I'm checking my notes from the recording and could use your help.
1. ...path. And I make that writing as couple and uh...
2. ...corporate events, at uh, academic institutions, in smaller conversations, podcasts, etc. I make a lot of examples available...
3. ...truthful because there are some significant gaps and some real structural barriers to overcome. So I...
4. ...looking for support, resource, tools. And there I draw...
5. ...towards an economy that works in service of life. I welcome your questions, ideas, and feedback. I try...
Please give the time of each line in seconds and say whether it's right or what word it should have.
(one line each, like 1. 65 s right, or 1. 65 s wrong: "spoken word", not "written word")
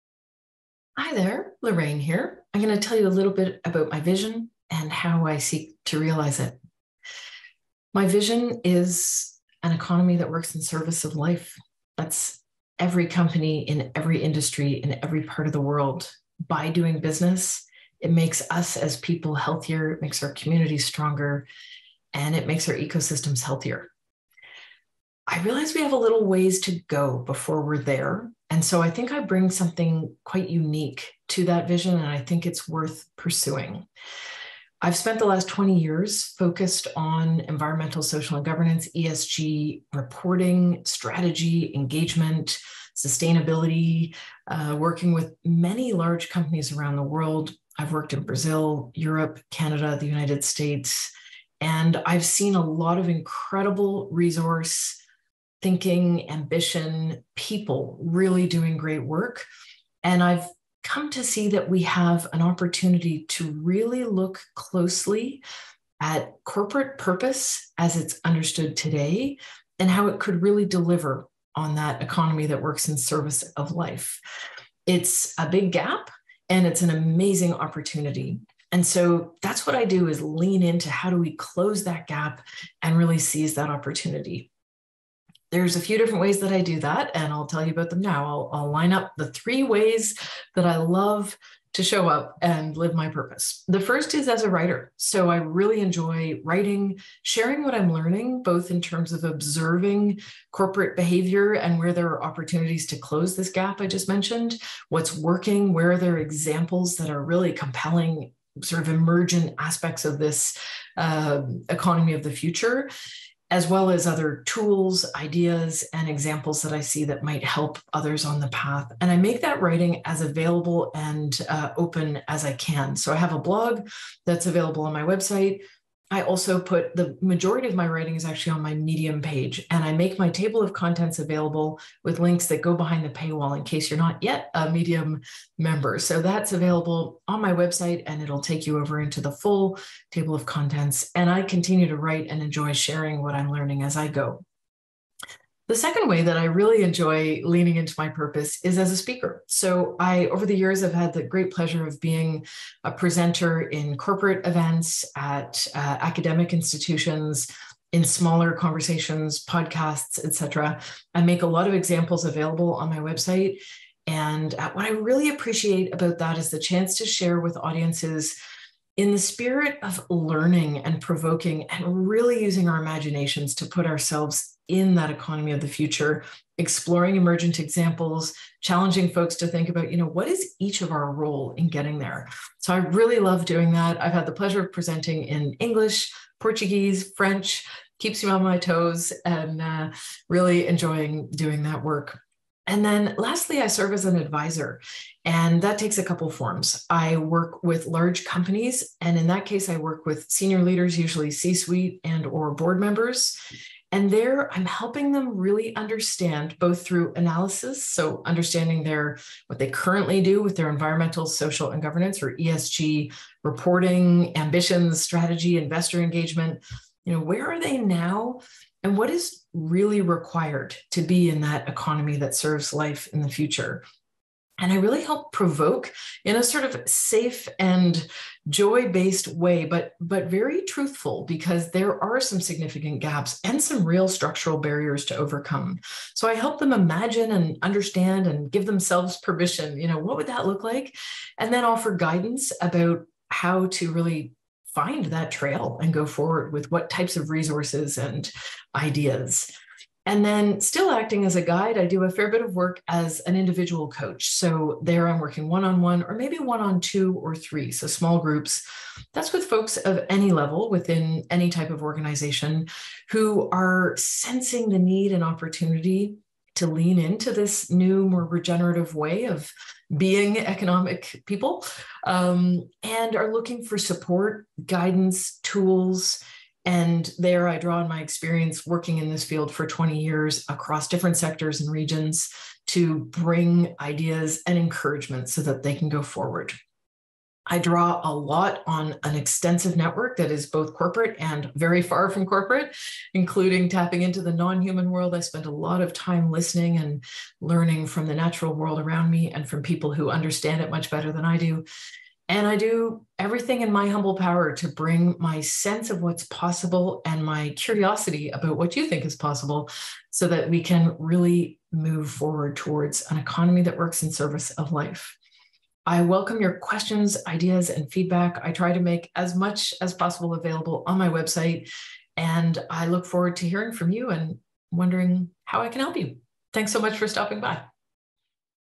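1. 118 s wrong: "available", not "couple"
2. 153 s right
3. 230 s right
4. 273 s wrong: "guidance", not "resource"
5. 312 s right.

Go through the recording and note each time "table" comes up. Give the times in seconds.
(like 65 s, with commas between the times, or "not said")
130 s, 140 s.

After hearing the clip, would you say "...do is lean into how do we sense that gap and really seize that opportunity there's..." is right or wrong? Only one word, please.
wrong.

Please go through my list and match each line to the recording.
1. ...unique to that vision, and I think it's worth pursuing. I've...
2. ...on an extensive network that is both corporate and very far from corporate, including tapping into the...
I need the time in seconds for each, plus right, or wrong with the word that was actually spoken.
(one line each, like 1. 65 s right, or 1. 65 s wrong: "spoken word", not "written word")
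1. 30 s right
2. 288 s right.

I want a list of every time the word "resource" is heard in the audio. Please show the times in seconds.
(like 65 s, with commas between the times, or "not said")
54 s, 247 s.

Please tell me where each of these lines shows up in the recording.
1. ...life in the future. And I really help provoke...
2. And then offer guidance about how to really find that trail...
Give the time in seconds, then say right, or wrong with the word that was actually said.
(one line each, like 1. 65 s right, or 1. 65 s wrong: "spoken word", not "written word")
1. 222 s right
2. 241 s right.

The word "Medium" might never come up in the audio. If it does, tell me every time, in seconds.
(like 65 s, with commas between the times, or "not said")
128 s, 134 s.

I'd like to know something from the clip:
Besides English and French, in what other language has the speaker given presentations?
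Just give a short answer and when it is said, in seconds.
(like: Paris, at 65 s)
Portuguese, at 186 s.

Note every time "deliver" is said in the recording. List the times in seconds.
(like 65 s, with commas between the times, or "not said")
70 s.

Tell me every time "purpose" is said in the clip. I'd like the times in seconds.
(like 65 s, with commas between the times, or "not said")
66 s, 93 s, 148 s.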